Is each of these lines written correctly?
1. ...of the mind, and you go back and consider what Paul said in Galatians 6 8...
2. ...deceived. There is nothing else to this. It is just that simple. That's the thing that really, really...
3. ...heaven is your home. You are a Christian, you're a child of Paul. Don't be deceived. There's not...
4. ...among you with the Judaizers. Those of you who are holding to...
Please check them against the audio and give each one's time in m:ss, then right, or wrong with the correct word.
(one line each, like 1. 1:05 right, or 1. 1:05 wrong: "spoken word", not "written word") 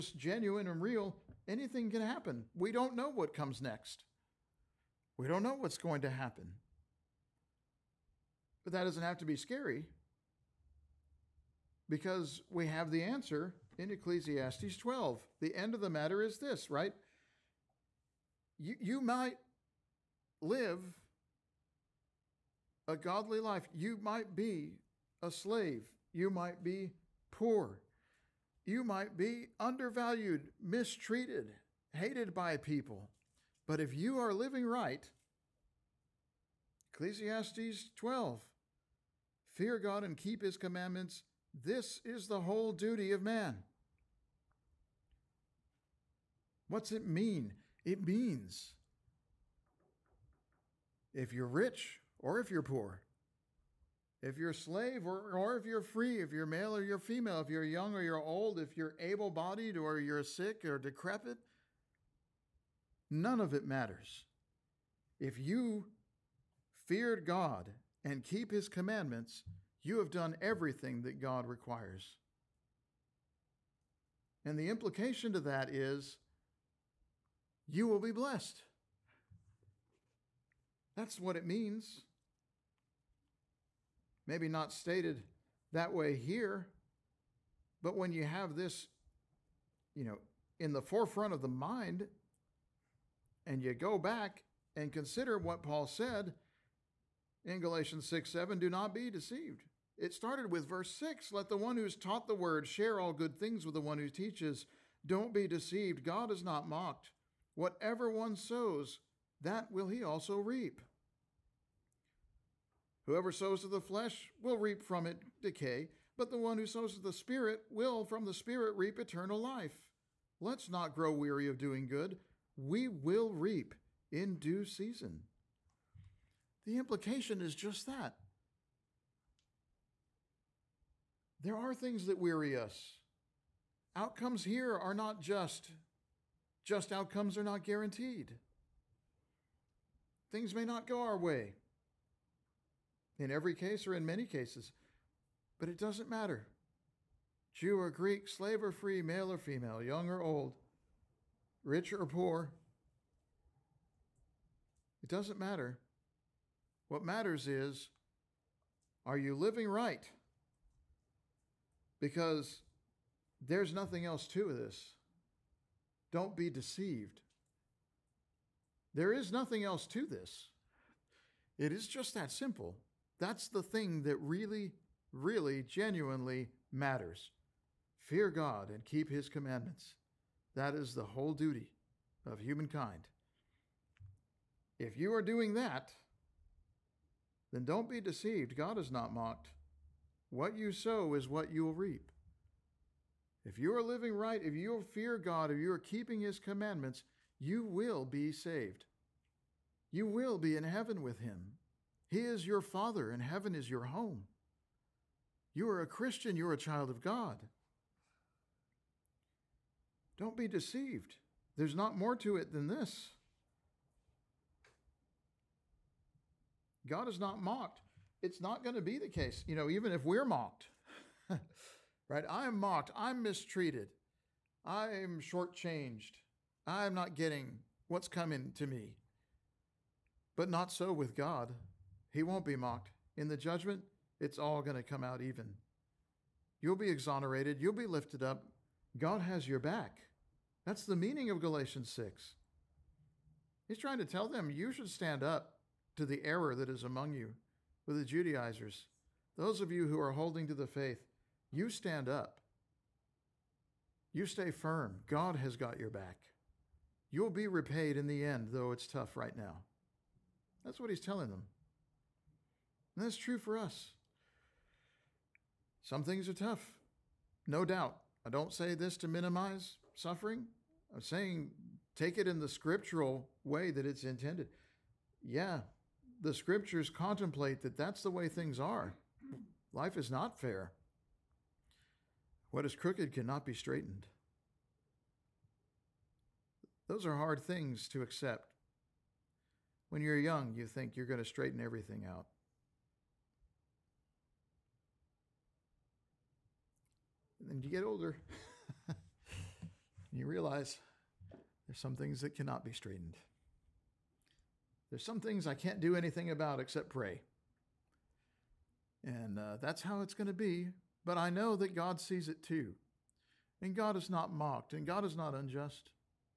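1. 1:31 wrong: "7", not "8"
2. 2:46 right
3. 3:23 wrong: "God", not "Paul"
4. 4:06 right.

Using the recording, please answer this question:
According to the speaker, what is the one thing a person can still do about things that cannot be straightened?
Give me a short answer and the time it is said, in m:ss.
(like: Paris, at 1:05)
Pray, at 5:06.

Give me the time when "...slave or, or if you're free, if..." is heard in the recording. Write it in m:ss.
0:54.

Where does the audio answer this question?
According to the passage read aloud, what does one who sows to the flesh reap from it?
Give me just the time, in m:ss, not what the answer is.
1:55.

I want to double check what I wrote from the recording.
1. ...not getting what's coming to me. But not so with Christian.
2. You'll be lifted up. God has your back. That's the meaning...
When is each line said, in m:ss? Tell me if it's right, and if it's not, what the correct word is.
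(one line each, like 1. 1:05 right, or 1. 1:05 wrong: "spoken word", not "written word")
1. 3:46 wrong: "God", not "Christian"
2. 3:57 right.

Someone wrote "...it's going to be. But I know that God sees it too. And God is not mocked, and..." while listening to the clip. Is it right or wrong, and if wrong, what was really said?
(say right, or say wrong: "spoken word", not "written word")
right.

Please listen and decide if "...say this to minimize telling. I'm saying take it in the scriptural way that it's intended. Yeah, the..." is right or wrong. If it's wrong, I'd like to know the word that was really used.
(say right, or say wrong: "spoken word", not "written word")
wrong: "suffering", not "telling".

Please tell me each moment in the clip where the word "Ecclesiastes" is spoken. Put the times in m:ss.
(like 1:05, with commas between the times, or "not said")
0:13, 0:36.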